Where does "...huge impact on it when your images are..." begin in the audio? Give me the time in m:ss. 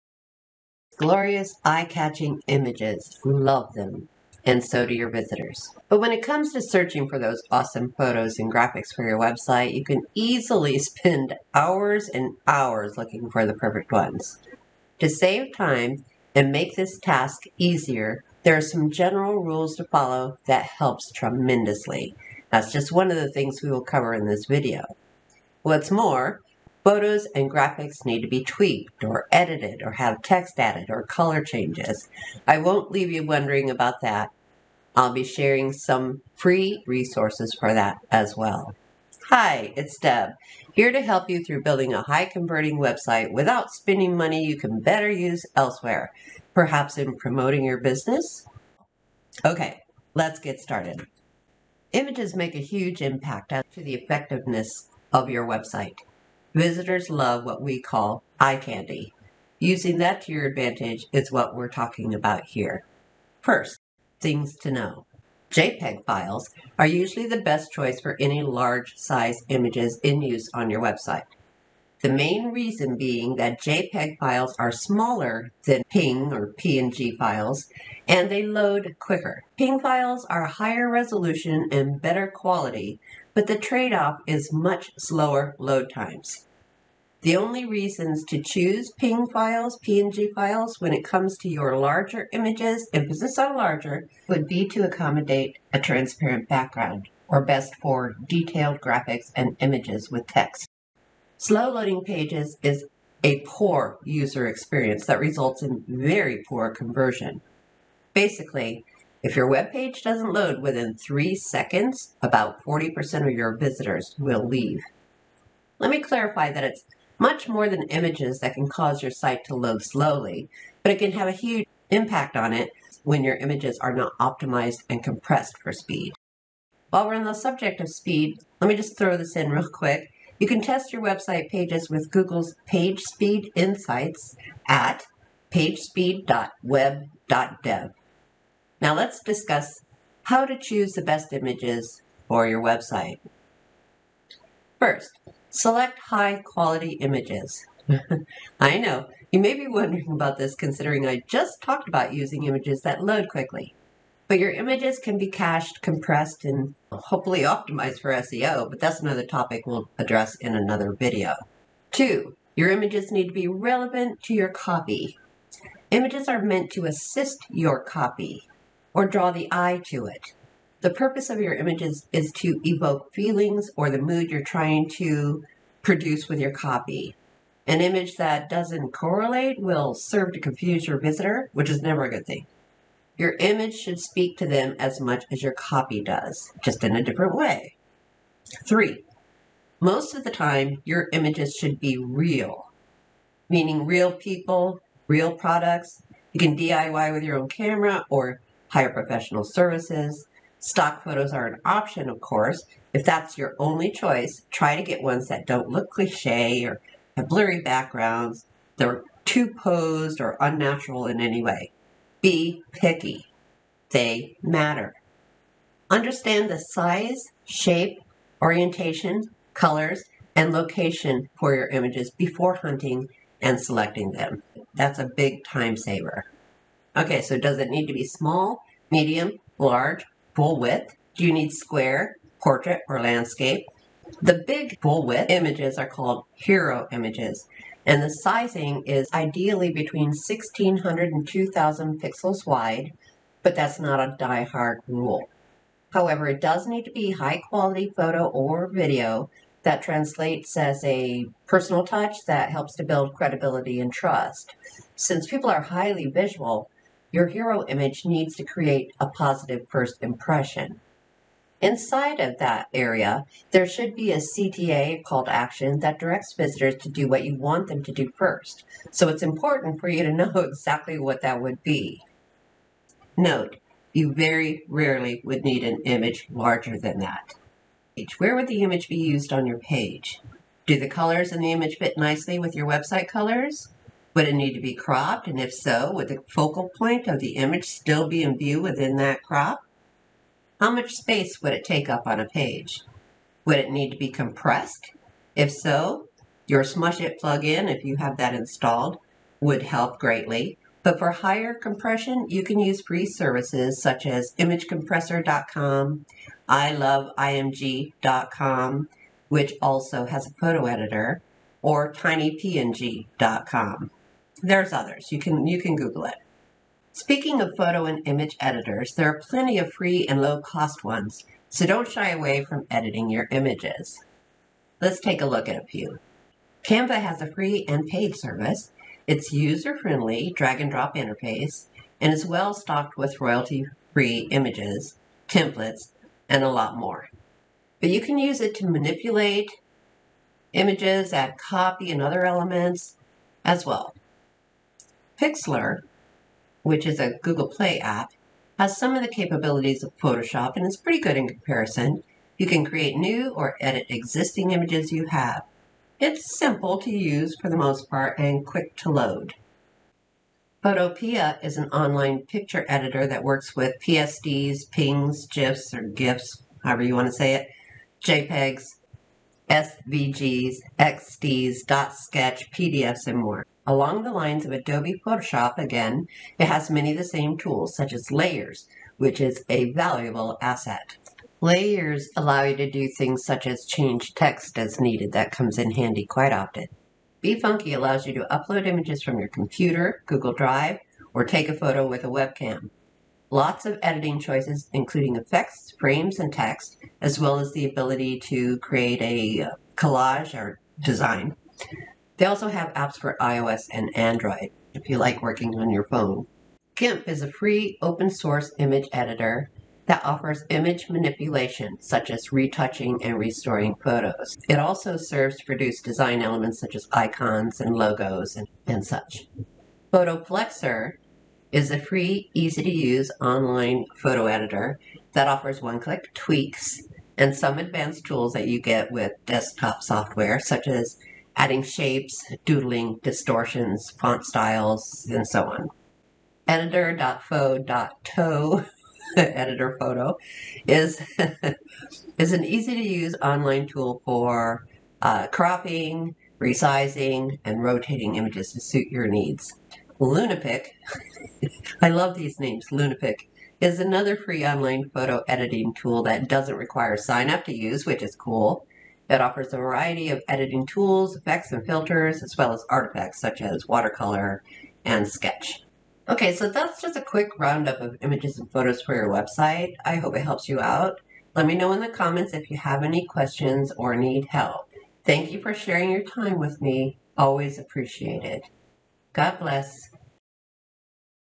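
2:01.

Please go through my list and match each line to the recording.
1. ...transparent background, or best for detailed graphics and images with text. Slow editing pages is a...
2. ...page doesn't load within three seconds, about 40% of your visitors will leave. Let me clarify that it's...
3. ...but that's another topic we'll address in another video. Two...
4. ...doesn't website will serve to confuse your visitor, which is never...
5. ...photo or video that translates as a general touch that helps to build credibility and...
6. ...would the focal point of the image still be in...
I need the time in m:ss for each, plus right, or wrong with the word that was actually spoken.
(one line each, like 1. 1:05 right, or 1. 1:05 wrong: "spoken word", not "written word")
1. 1:35 wrong: "loading", not "editing"
2. 1:49 right
3. 2:38 right
4. 2:58 wrong: "correlate", not "website"
5. 4:07 wrong: "personal", not "general"
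6. 4:45 right.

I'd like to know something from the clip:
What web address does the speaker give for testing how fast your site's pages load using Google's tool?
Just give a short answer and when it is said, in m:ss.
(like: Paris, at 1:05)
pagespeed.web.dev, at 2:15.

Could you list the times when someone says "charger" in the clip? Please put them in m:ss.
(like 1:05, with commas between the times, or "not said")
not said.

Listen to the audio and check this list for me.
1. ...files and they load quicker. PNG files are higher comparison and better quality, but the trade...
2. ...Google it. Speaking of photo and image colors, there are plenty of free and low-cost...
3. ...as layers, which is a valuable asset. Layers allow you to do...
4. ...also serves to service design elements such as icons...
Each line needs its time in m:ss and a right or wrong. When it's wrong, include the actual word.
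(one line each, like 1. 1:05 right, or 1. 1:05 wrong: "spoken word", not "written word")
1. 1:17 wrong: "resolution", not "comparison"
2. 5:15 wrong: "editors", not "colors"
3. 6:17 right
4. 6:54 wrong: "produce", not "service".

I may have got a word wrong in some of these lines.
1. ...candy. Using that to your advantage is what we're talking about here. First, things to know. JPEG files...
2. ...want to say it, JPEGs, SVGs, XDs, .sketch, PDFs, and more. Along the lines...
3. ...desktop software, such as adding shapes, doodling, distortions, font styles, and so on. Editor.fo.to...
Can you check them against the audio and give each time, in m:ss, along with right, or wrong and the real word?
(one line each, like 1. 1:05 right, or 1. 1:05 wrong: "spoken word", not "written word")
1. 0:58 right
2. 6:06 right
3. 7:09 right.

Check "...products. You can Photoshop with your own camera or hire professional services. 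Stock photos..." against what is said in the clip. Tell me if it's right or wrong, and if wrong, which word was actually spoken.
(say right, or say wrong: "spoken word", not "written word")
wrong: "DIY", not "Photoshop".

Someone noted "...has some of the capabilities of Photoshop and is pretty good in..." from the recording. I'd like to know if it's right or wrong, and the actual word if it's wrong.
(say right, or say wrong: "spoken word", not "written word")
right.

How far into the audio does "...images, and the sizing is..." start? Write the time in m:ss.
3:56.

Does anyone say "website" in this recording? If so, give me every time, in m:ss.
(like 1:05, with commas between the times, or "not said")
0:09, 0:42, 0:55, 1:10, 2:11, 2:22, 4:42, 7:49.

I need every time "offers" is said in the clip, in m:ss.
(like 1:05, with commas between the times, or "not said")
6:50, 7:05, 7:39.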